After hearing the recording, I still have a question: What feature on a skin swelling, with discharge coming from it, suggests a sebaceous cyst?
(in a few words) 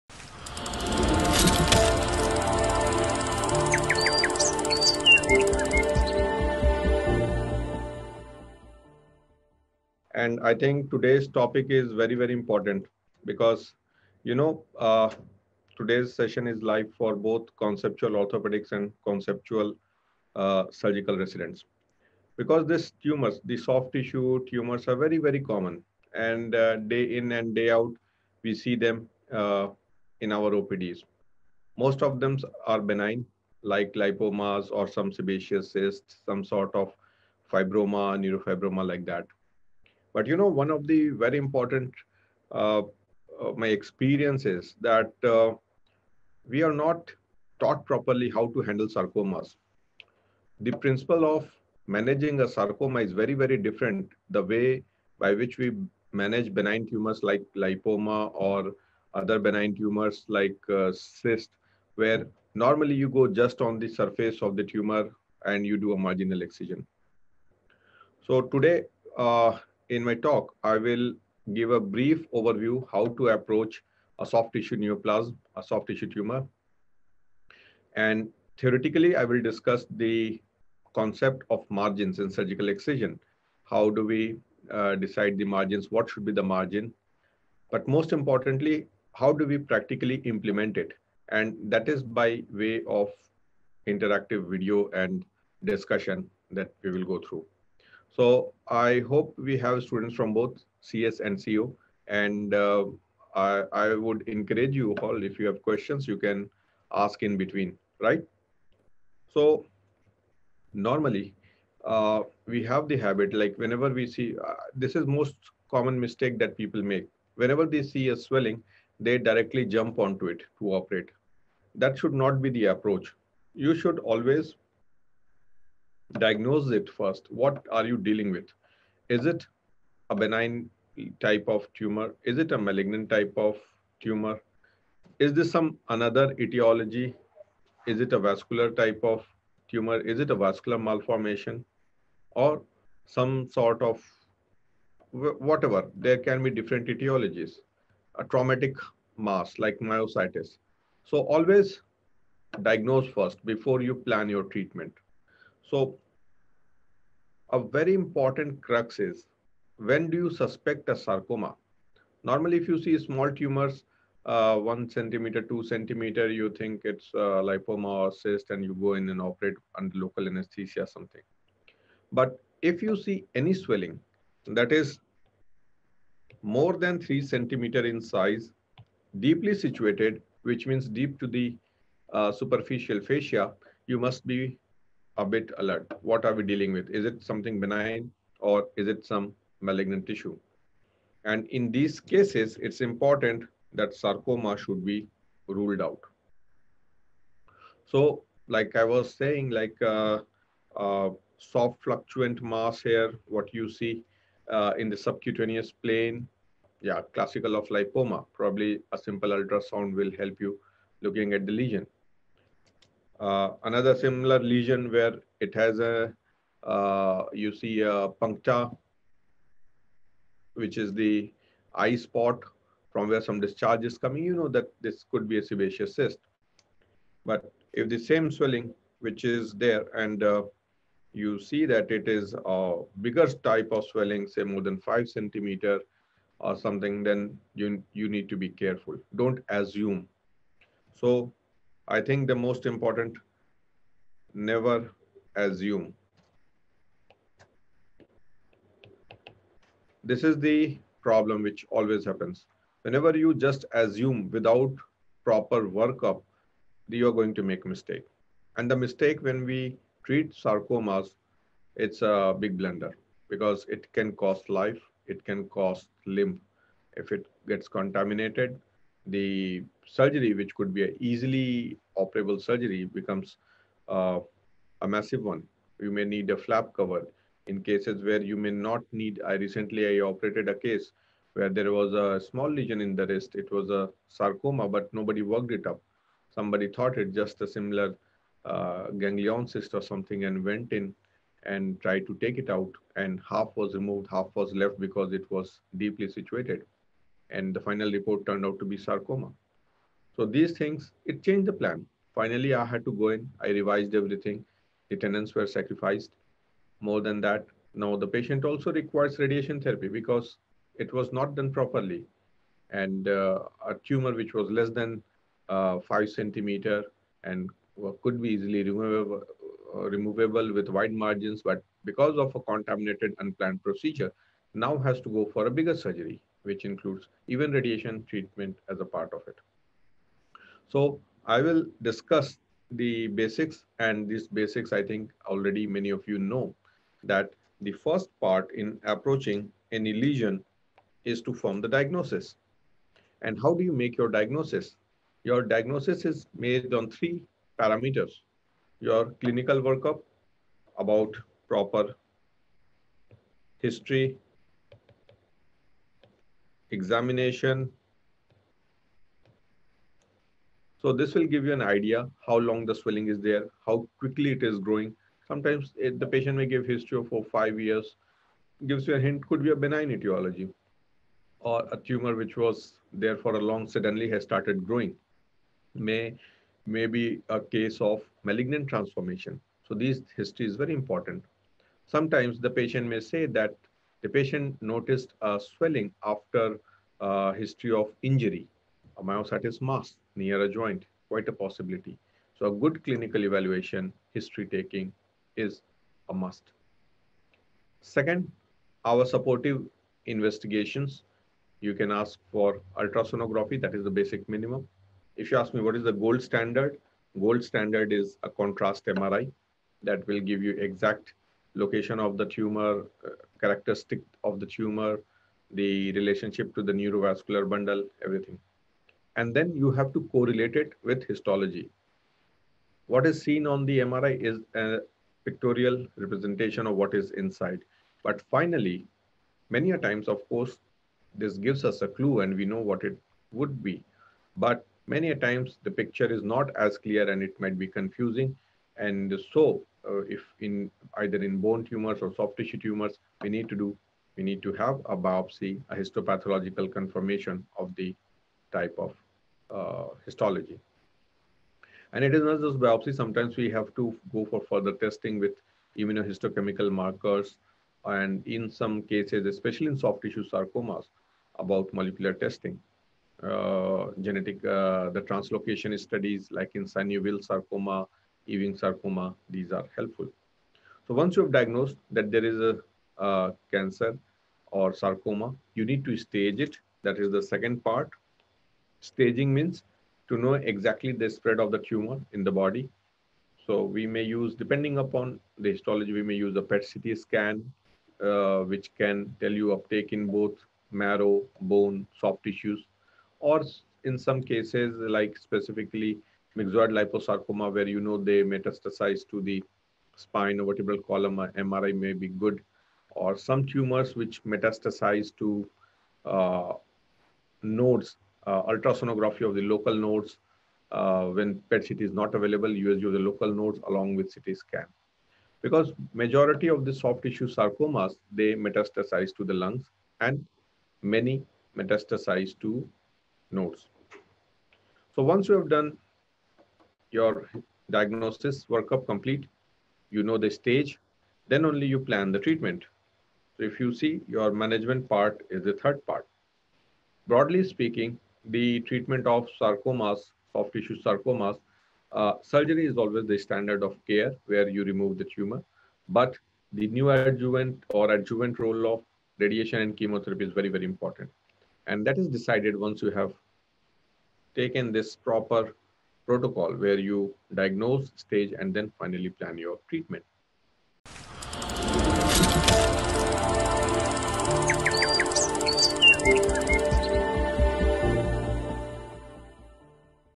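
A puncta.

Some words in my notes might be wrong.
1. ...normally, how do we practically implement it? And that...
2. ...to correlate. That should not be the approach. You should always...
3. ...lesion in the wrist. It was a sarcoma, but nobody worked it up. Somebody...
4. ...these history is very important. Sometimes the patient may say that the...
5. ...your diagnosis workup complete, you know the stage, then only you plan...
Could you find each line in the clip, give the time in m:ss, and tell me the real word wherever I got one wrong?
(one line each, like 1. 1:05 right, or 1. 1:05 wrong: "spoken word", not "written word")
1. 1:28 wrong: "importantly", not "normally"
2. 2:00 wrong: "operate", not "correlate"
3. 4:42 right
4. 6:19 right
5. 8:46 right.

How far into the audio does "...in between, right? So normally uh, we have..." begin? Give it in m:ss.
1:47.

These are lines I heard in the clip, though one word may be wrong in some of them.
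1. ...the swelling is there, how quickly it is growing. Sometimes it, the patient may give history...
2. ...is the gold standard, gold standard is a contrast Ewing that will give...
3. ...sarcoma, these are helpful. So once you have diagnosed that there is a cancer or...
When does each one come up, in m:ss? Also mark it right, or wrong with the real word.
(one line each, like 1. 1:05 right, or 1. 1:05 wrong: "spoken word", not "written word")
1. 6:02 right
2. 6:45 wrong: "MRI", not "Ewing"
3. 7:48 right.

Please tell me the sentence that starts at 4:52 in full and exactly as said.
And half was removed, half was left because it was deeply situated and the final report turned out to be sarcoma.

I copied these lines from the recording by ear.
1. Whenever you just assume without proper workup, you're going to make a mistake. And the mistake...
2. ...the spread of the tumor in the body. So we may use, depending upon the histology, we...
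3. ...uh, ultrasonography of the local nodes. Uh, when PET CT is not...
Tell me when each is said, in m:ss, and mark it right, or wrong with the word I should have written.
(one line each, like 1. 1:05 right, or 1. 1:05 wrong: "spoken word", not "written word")
1. 4:12 right
2. 8:00 right
3. 8:28 right.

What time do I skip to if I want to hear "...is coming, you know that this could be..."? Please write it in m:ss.
3:43.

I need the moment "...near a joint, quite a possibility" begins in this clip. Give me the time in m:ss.
6:30.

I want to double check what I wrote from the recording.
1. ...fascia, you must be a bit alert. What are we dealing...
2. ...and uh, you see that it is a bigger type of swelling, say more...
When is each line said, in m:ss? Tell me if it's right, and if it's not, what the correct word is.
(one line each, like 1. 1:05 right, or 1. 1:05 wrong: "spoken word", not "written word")
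1. 3:02 right
2. 3:49 right.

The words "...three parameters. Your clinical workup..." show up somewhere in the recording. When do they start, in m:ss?
5:46.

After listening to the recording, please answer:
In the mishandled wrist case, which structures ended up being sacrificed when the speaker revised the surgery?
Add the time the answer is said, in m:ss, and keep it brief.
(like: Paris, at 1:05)
Tendons, at 5:04.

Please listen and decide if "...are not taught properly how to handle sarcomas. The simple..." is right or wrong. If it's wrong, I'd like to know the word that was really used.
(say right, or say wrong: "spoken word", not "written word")
wrong: "principle", not "simple".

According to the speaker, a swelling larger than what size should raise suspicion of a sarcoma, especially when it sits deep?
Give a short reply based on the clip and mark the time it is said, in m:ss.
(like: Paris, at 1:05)
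3 centimeters, at 2:56.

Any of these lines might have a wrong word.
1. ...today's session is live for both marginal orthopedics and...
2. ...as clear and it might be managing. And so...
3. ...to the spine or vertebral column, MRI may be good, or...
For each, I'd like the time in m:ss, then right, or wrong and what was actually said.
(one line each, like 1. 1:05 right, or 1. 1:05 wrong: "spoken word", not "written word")
1. 0:15 wrong: "conceptual", not "marginal"
2. 7:16 wrong: "confusing", not "managing"
3. 8:19 right.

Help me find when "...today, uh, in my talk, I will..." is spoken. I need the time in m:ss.
1:08.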